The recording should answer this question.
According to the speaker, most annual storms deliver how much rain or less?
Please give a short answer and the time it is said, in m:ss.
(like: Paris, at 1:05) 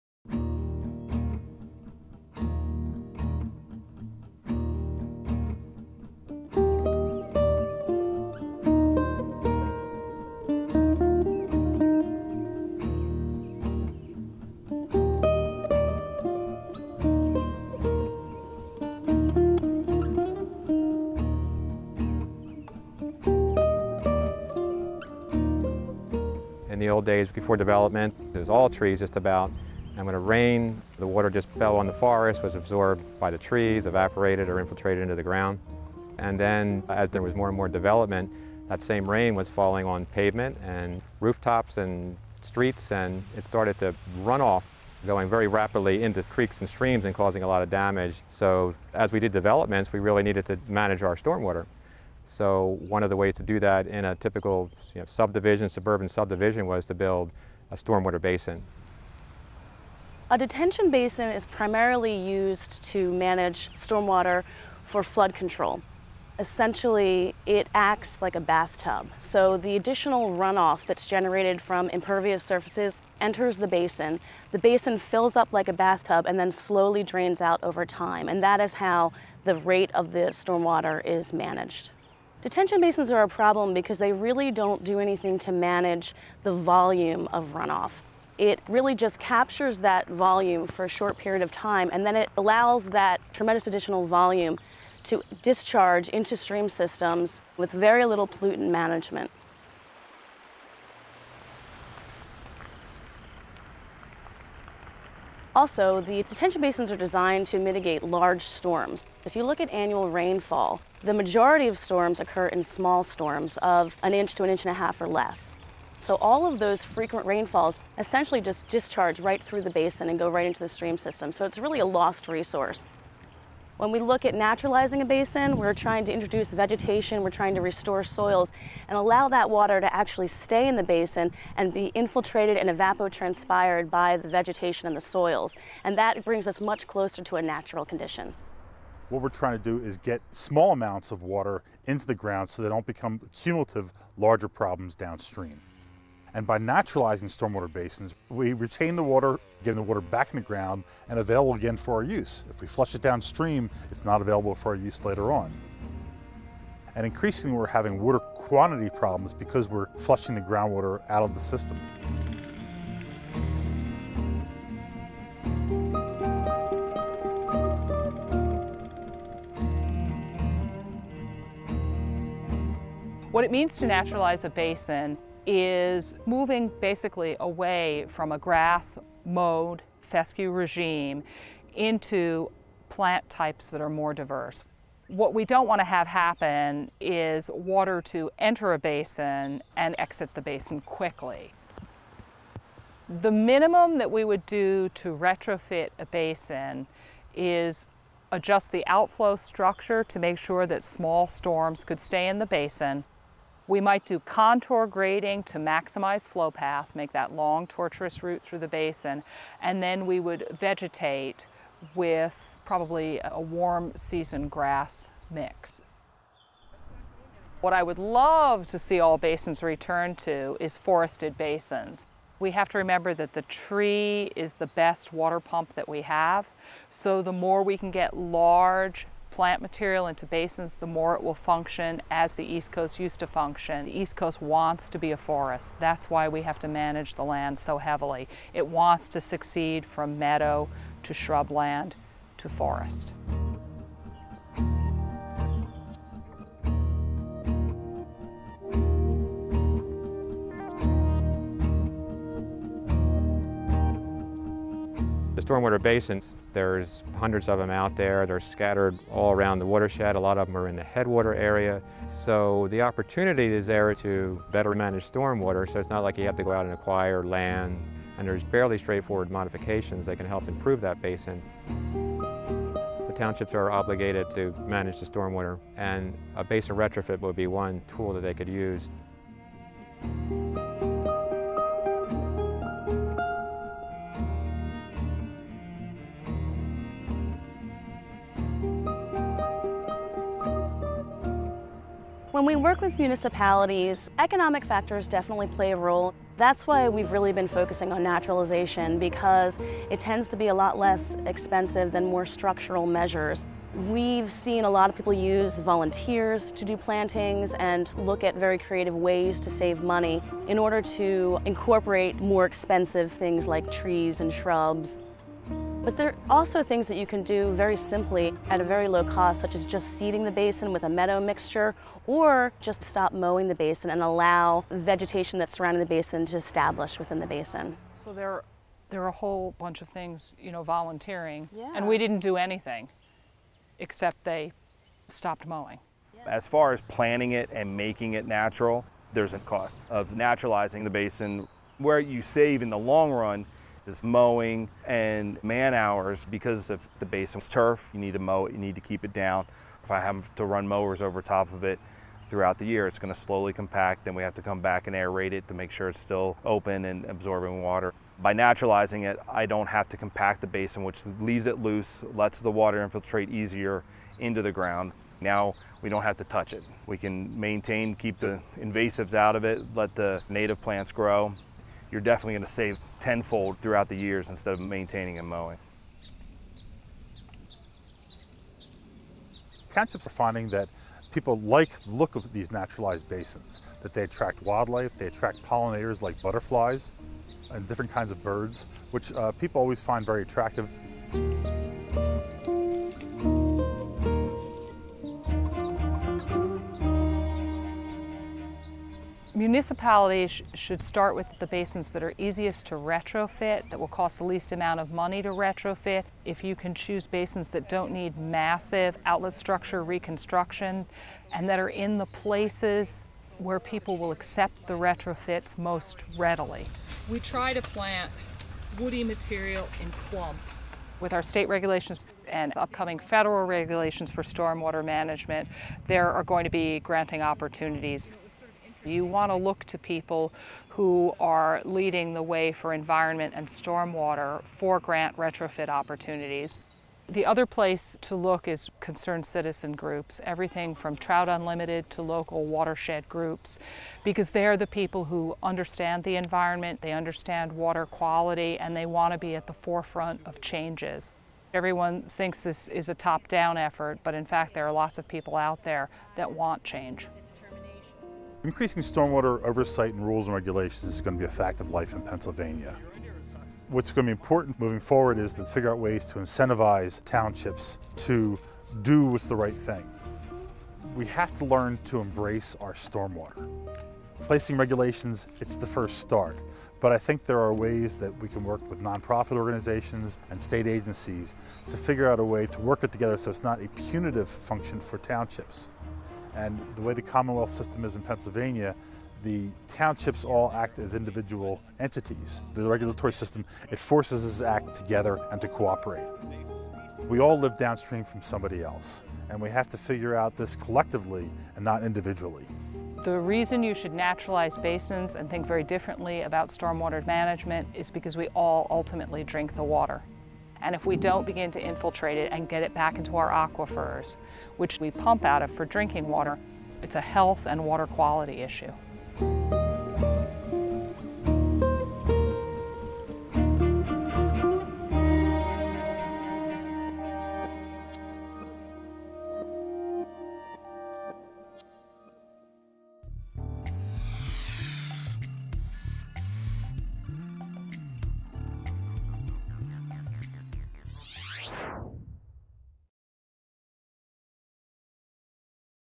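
An inch to an inch and a half, at 1:54.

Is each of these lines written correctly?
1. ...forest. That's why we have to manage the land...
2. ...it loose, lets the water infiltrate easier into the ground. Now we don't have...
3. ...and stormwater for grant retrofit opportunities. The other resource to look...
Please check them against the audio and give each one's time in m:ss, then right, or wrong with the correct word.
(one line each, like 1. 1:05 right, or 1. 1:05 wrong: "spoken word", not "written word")
1. 3:55 right
2. 6:01 right
3. 7:13 wrong: "place", not "resource".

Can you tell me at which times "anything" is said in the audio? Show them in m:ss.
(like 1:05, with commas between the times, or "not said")
1:24, 5:32.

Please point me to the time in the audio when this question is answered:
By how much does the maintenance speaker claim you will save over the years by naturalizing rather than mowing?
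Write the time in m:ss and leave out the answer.
6:12.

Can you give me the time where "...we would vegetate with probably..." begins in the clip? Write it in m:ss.
3:30.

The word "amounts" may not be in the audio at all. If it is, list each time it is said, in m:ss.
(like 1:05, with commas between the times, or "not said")
2:20, 6:44.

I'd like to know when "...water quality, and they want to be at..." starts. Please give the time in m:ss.
7:27.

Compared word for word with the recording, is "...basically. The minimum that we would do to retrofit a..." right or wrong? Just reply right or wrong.
wrong.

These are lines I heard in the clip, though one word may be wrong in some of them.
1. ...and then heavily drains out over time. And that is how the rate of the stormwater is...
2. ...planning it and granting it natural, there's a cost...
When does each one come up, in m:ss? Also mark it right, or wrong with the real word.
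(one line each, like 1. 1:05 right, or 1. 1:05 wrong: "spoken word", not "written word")
1. 1:16 wrong: "slowly", not "heavily"
2. 5:36 wrong: "making", not "granting".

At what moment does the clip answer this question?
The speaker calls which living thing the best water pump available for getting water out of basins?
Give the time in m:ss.
3:43.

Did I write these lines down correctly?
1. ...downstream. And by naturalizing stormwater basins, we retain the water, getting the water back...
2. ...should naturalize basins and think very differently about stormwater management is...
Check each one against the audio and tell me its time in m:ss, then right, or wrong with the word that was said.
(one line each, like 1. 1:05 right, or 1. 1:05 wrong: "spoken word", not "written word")
1. 2:24 right
2. 8:23 right.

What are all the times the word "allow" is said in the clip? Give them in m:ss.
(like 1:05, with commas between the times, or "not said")
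1:32, 2:08, 5:24.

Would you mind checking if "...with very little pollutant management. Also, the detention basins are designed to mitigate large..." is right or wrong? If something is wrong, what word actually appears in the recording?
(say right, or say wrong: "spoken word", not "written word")
right.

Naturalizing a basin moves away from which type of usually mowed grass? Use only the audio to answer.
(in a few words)
Fescue.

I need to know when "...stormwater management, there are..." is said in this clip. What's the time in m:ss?
7:04.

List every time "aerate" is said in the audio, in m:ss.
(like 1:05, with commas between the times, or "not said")
5:54.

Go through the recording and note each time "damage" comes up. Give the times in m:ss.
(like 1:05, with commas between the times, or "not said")
0:47.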